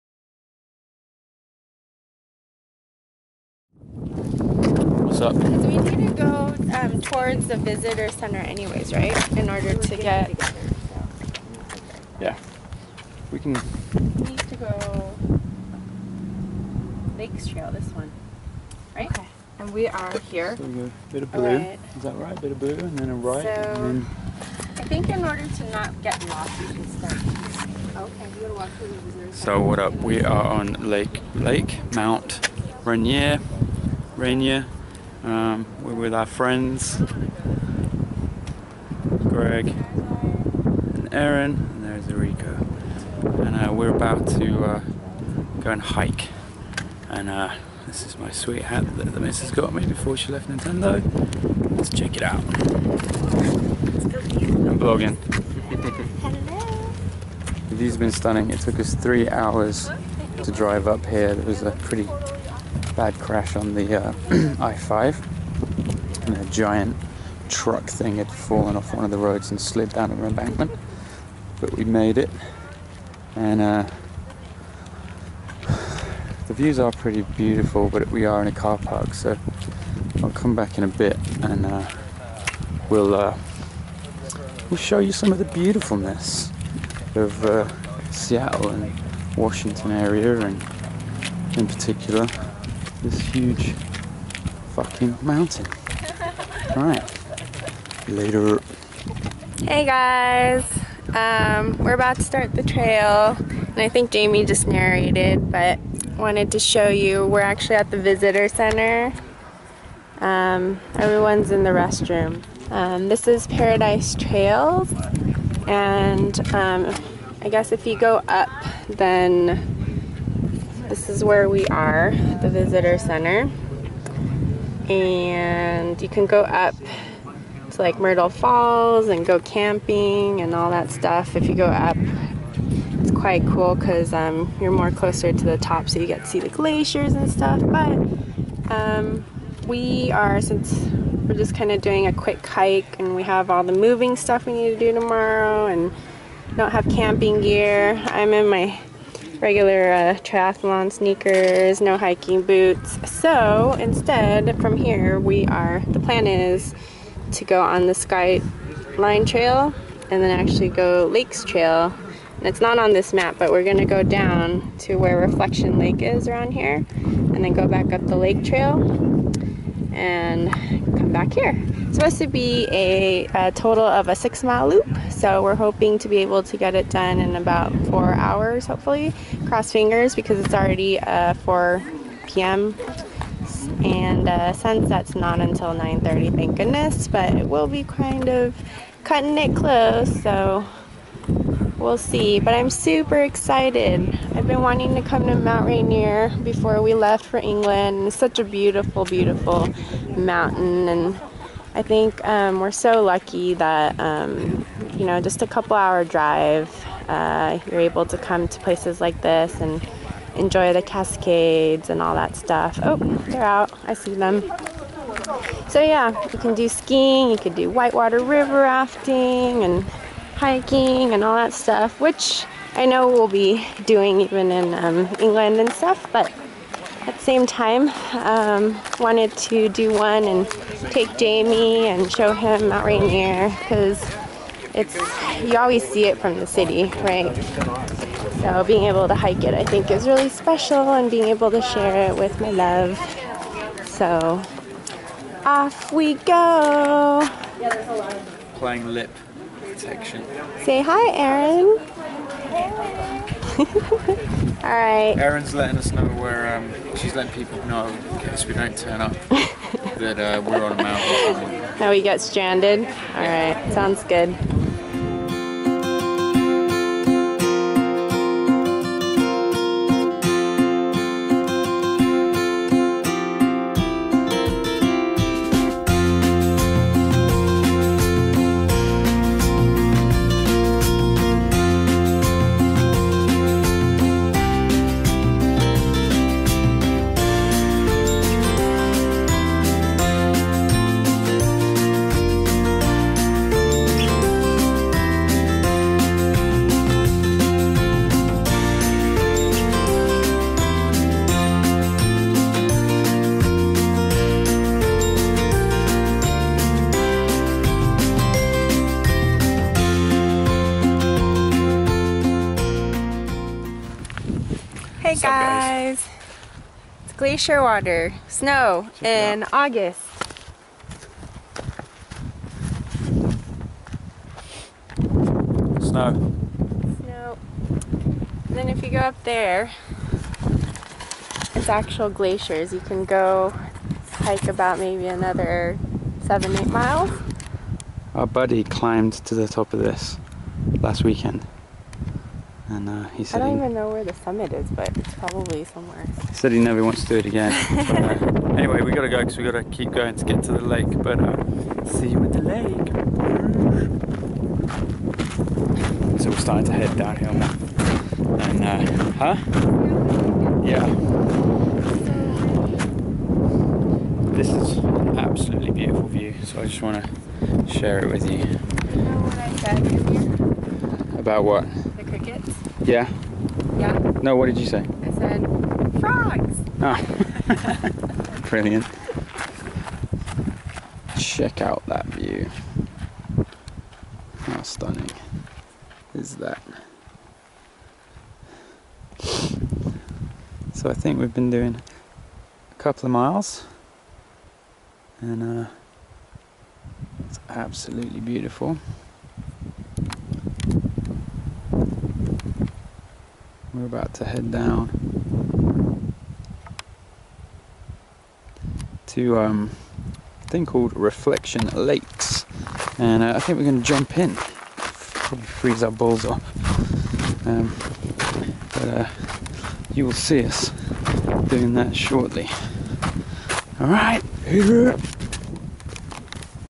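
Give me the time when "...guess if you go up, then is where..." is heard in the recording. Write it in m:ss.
1:57.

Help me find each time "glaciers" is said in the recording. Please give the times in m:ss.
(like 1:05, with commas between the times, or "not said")
2:16, 5:17, 5:32.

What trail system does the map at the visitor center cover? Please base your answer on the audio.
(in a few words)
Paradise Trails.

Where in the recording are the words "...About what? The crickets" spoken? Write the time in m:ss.
6:11.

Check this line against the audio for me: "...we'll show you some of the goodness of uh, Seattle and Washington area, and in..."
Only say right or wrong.
wrong.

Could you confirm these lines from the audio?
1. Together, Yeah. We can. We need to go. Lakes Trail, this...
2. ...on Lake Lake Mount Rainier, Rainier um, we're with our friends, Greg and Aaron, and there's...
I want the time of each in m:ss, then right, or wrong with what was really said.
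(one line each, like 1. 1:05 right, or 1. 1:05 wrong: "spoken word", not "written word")
1. 0:10 right
2. 0:30 right.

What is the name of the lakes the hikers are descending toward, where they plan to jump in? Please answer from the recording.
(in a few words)
Reflection Lakes.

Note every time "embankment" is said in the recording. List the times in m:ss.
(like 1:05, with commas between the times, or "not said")
1:10.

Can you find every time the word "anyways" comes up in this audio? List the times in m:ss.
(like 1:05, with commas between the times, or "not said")
0:08, 5:48.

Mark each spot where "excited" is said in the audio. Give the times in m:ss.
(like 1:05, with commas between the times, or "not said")
3:13.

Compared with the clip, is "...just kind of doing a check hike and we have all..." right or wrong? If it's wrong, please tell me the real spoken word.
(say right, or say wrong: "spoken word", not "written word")
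wrong: "quick", not "check".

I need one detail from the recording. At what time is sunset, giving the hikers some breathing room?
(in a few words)
9:30.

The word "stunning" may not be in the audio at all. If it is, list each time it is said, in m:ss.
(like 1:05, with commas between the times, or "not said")
0:58, 6:24.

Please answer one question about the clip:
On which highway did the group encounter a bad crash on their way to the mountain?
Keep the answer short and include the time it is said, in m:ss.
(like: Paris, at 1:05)
I5, at 1:04.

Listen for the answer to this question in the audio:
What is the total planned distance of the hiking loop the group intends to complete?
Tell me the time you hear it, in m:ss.
2:54.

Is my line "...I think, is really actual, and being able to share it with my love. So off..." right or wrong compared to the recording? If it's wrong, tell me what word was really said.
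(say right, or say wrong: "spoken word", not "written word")
wrong: "special", not "actual".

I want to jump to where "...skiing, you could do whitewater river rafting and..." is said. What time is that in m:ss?
3:36.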